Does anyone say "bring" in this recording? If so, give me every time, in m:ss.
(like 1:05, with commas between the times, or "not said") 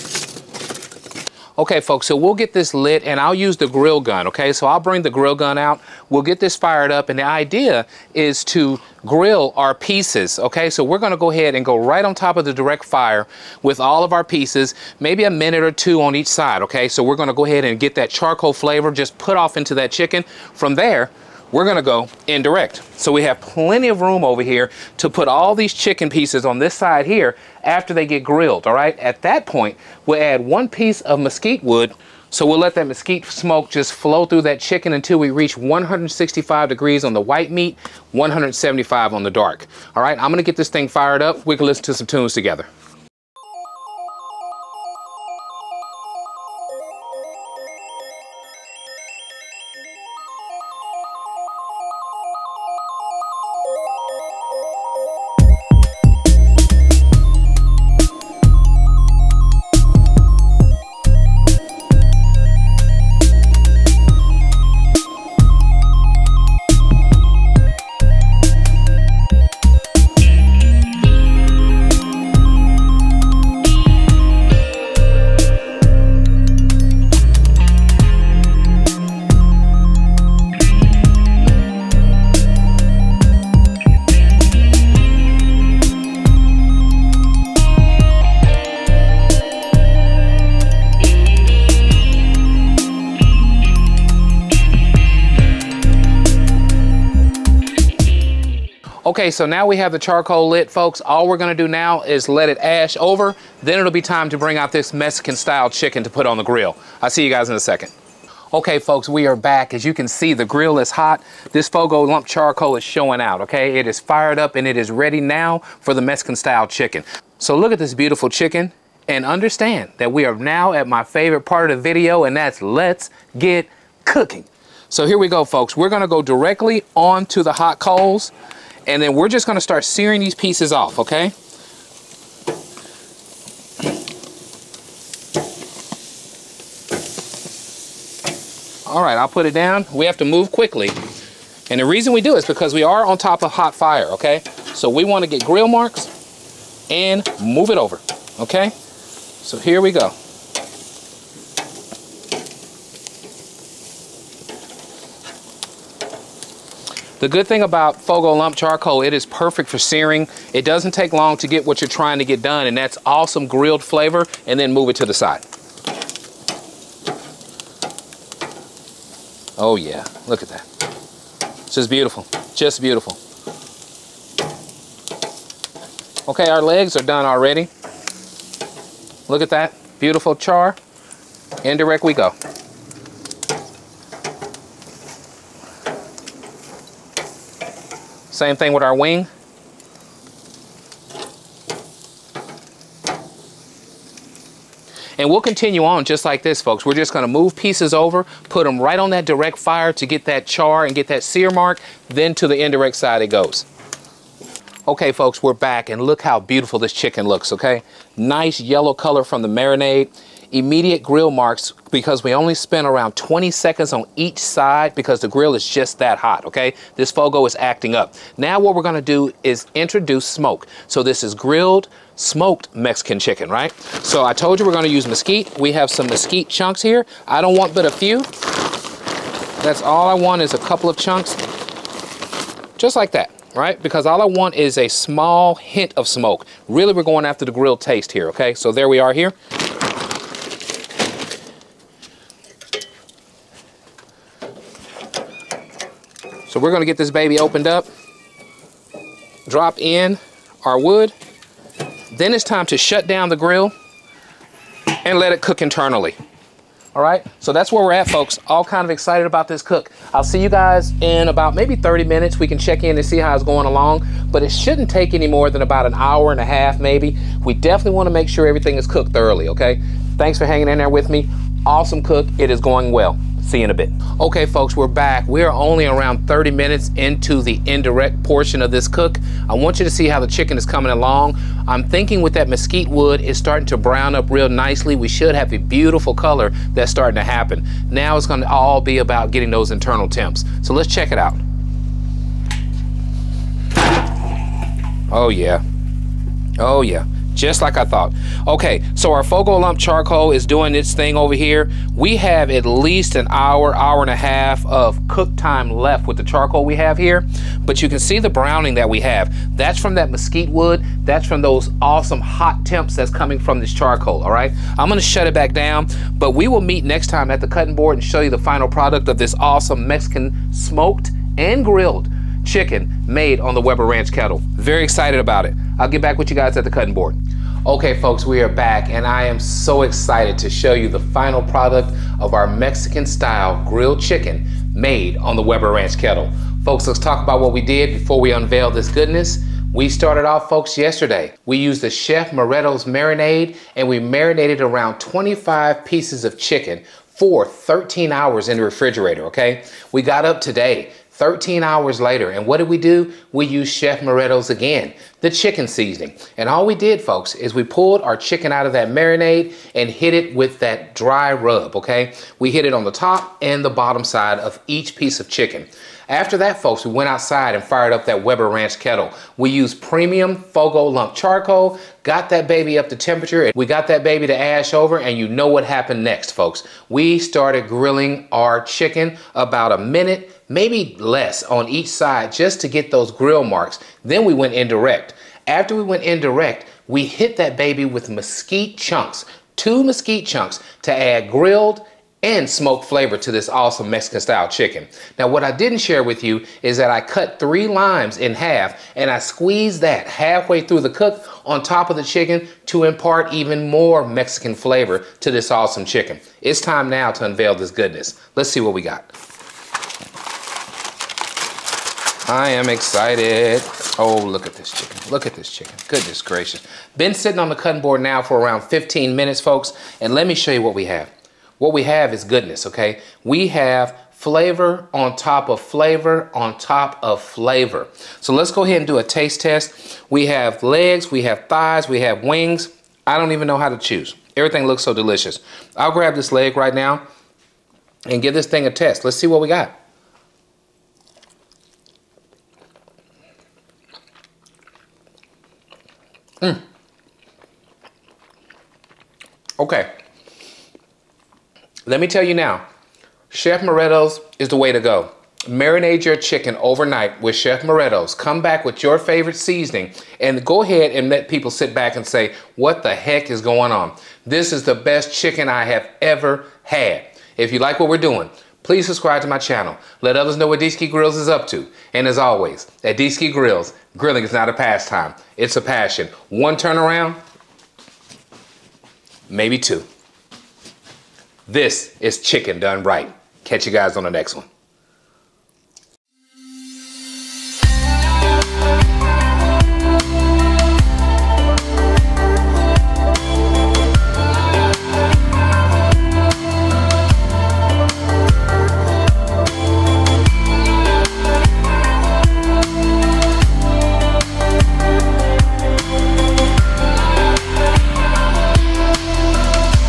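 0:04, 1:44.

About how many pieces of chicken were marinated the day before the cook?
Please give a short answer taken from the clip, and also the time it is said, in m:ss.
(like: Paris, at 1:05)
25, at 5:44.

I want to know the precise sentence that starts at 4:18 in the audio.
All kind of excited about this cook.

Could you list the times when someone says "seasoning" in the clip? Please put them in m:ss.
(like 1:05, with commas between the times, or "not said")
5:55, 7:39.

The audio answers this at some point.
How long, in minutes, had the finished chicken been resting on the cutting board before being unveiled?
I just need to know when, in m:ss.
6:58.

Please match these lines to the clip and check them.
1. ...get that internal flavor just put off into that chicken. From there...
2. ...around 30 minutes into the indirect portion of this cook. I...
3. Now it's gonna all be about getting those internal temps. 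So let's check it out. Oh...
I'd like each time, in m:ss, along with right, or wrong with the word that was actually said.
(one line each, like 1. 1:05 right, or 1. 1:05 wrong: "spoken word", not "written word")
1. 0:17 wrong: "charcoal", not "internal"
2. 4:35 right
3. 4:47 right.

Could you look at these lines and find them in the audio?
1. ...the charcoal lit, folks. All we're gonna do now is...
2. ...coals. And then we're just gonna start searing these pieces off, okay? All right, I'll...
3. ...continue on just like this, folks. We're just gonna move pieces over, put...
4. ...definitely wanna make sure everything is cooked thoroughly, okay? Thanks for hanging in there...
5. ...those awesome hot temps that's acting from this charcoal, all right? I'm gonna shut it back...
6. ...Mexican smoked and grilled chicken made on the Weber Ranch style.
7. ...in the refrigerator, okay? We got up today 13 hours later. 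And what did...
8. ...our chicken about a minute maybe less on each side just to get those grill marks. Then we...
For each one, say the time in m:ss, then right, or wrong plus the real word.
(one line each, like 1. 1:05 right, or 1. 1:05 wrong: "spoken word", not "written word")
1. 1:39 right
2. 2:07 right
3. 3:15 right
4. 4:27 right
5. 5:11 wrong: "coming", not "acting"
6. 5:19 wrong: "kettle", not "style"
7. 5:48 right
8. 6:18 right.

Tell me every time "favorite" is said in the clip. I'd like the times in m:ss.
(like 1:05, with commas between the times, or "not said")
2:01, 7:38.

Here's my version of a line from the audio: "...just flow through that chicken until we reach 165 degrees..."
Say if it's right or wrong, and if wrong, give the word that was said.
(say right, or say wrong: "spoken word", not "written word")
right.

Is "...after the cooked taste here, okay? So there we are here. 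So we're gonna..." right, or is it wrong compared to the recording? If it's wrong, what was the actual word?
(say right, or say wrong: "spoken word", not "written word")
wrong: "grilled", not "cooked".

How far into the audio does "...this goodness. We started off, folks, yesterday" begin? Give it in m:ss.
5:38.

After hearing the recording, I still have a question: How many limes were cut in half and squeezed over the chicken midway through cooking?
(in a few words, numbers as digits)
3.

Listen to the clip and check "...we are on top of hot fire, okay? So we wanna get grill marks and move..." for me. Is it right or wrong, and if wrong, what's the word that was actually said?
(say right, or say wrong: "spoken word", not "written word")
right.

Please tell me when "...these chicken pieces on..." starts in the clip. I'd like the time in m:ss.
0:25.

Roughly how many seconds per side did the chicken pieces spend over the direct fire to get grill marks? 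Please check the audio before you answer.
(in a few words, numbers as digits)
20.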